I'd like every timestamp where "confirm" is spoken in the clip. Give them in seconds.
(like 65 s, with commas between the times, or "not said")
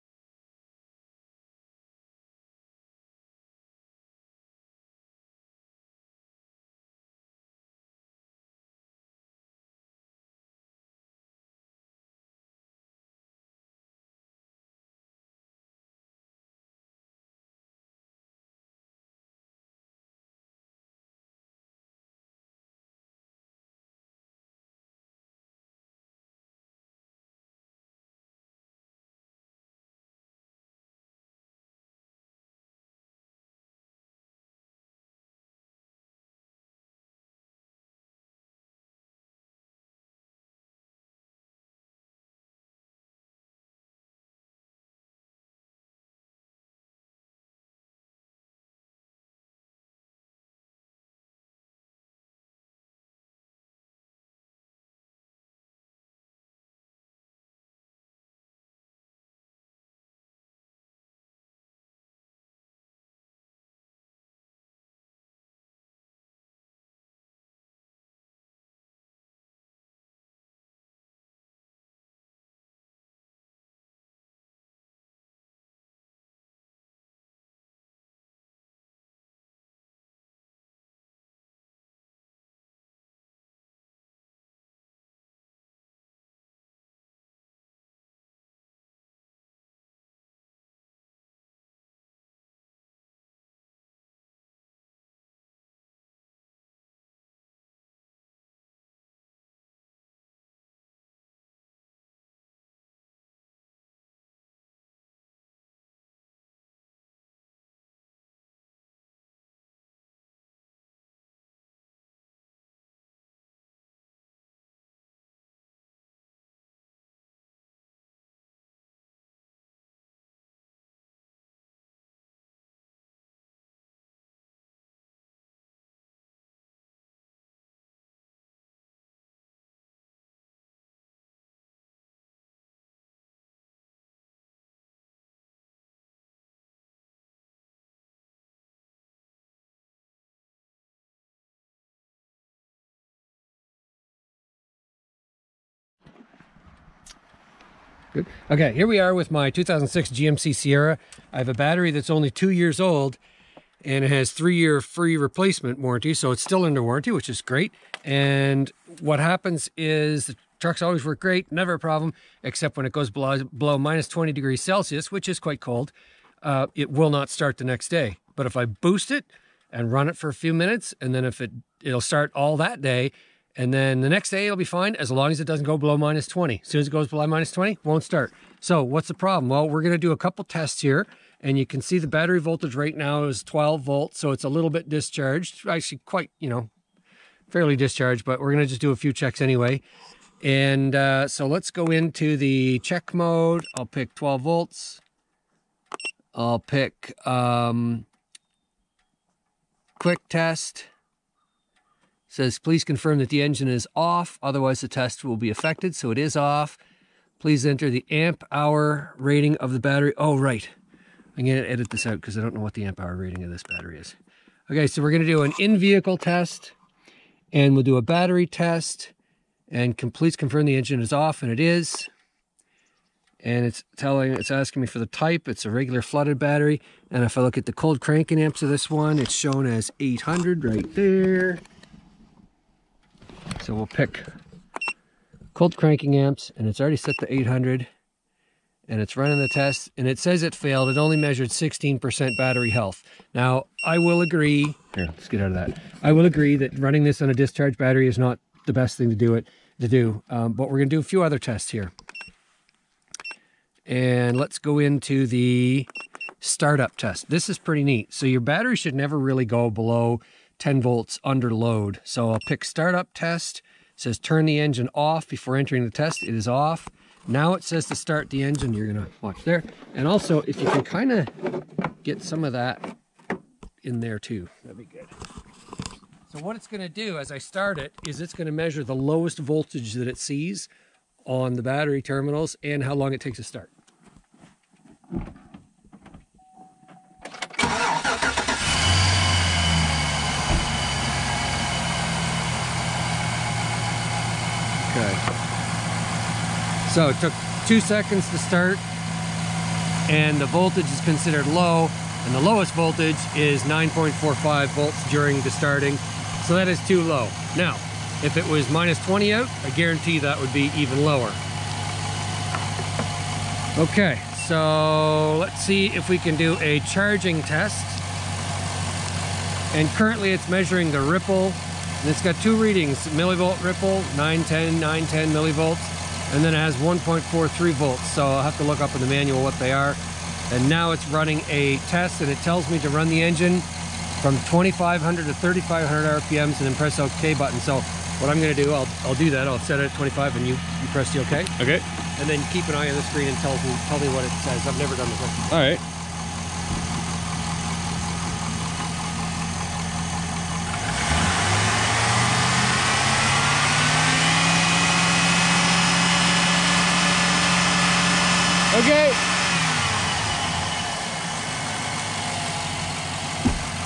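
202 s, 220 s.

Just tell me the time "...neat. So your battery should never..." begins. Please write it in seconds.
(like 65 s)
257 s.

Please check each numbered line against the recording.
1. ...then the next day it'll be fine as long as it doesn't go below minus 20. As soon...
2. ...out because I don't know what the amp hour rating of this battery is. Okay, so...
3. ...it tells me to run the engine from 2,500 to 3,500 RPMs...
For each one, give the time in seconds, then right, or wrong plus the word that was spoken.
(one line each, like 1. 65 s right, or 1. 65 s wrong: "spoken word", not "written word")
1. 173 s right
2. 212 s right
3. 332 s right.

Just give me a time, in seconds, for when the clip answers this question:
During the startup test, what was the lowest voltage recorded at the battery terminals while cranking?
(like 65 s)
303 s.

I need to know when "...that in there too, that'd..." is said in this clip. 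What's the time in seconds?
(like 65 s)
272 s.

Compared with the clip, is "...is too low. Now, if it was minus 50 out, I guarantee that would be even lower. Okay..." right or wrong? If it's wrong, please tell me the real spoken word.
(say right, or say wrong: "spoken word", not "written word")
wrong: "20", not "50".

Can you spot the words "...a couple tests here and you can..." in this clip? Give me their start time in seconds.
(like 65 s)
180 s.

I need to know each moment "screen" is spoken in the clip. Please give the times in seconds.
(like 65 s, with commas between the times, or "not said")
343 s.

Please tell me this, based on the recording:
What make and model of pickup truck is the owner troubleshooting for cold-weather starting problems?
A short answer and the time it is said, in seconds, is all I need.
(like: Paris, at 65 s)
GMC Sierra, at 150 s.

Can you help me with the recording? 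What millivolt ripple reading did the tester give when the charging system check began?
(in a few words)
910 millivolts.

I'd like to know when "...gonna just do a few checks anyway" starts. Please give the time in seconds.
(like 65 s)
188 s.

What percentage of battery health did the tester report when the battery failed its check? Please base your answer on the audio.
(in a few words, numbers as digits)
16%.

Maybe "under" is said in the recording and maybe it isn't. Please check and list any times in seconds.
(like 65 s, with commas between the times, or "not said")
156 s, 261 s.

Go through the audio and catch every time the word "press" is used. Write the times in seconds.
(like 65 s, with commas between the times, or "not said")
336 s, 340 s.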